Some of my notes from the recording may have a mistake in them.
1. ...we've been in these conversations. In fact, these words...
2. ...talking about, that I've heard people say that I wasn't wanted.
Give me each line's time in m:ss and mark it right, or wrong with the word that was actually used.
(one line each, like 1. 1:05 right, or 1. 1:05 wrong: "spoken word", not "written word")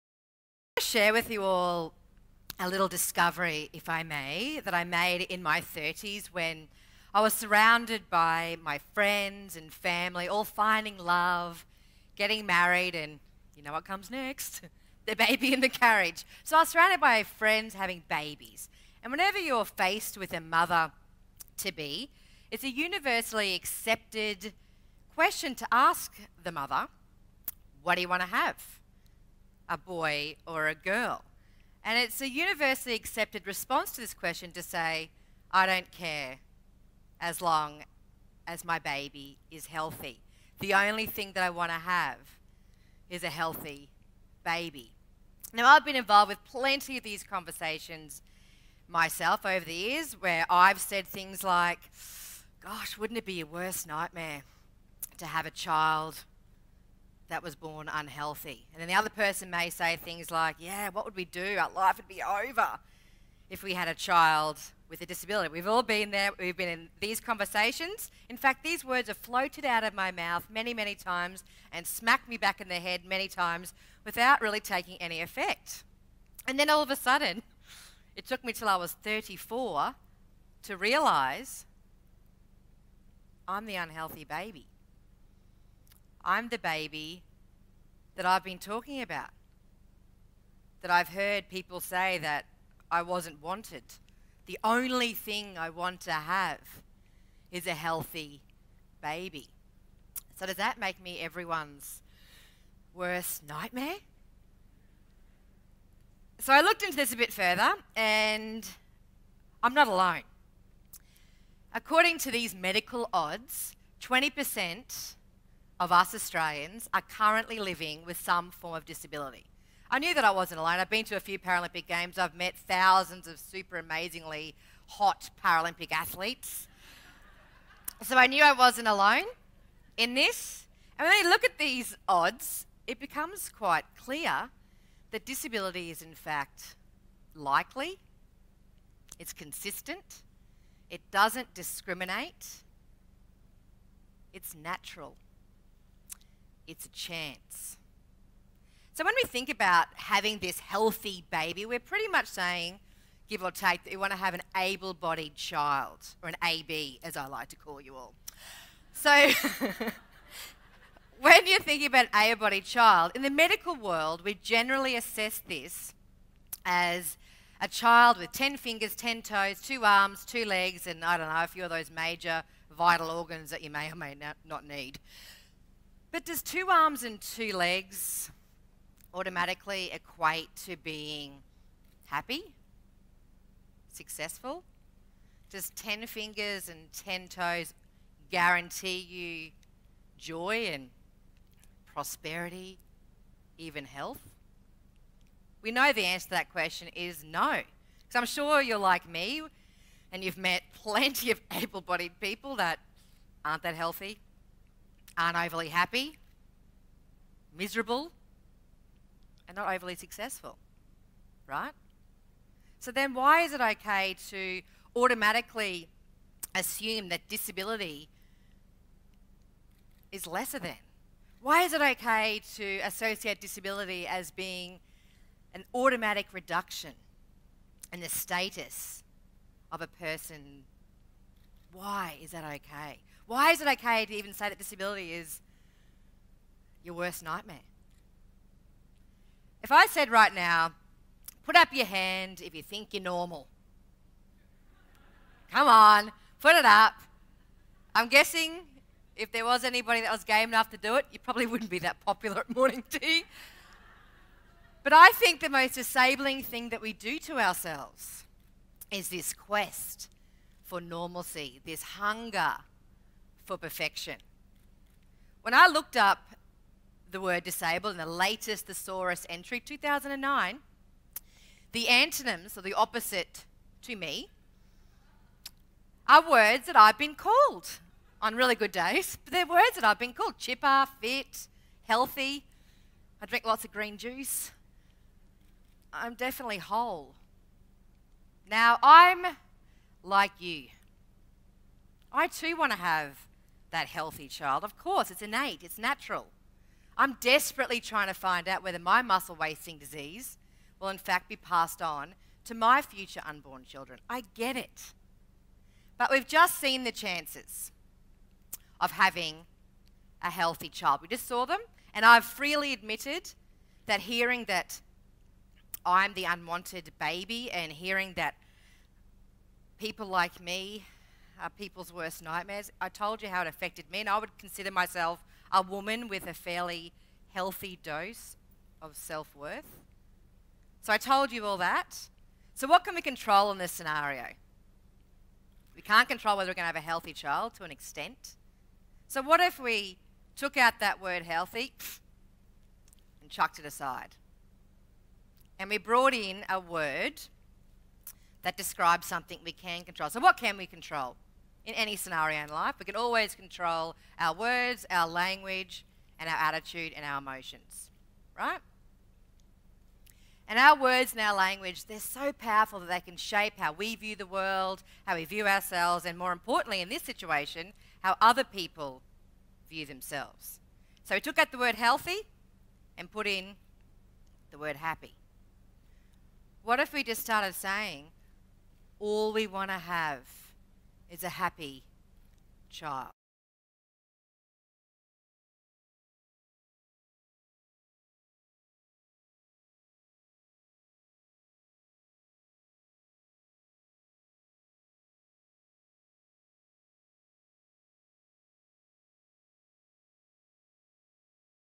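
1. 1:06 right
2. 1:28 right.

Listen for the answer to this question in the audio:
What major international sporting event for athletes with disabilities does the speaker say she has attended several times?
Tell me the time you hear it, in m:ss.
2:01.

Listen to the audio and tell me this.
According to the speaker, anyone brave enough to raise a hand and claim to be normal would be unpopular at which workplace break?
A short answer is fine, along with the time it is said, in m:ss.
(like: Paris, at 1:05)
morning tea, at 4:12.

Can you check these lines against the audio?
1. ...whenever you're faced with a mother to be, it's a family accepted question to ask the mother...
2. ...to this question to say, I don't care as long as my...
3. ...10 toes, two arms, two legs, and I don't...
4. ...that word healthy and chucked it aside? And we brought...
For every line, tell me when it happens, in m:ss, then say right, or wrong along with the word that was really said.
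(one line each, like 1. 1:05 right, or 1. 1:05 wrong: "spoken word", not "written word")
1. 0:19 wrong: "universally", not "family"
2. 0:33 right
3. 2:48 right
4. 5:40 right.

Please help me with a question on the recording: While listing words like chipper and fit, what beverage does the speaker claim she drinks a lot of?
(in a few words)
green juice.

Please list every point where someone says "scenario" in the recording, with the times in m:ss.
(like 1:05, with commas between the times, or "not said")
5:33, 5:51.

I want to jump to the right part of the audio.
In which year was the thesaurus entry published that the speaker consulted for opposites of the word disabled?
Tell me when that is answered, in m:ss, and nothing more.
4:29.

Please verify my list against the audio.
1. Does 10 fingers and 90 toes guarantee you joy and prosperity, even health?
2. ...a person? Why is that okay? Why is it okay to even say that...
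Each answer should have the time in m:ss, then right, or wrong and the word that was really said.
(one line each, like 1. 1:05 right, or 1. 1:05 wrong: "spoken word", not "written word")
1. 3:05 wrong: "10", not "90"
2. 3:49 right.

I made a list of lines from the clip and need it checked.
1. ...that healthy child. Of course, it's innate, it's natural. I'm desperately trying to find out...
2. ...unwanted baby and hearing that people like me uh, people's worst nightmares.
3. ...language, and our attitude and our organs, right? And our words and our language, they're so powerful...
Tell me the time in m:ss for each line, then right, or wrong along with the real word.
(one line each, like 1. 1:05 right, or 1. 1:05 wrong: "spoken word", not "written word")
1. 4:53 right
2. 5:16 right
3. 5:55 wrong: "emotions", not "organs".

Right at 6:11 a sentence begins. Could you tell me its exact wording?
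So we took out the word healthy and put in the word happy.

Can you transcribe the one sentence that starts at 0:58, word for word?
And then the other person may say things like, Yeah, what would we do?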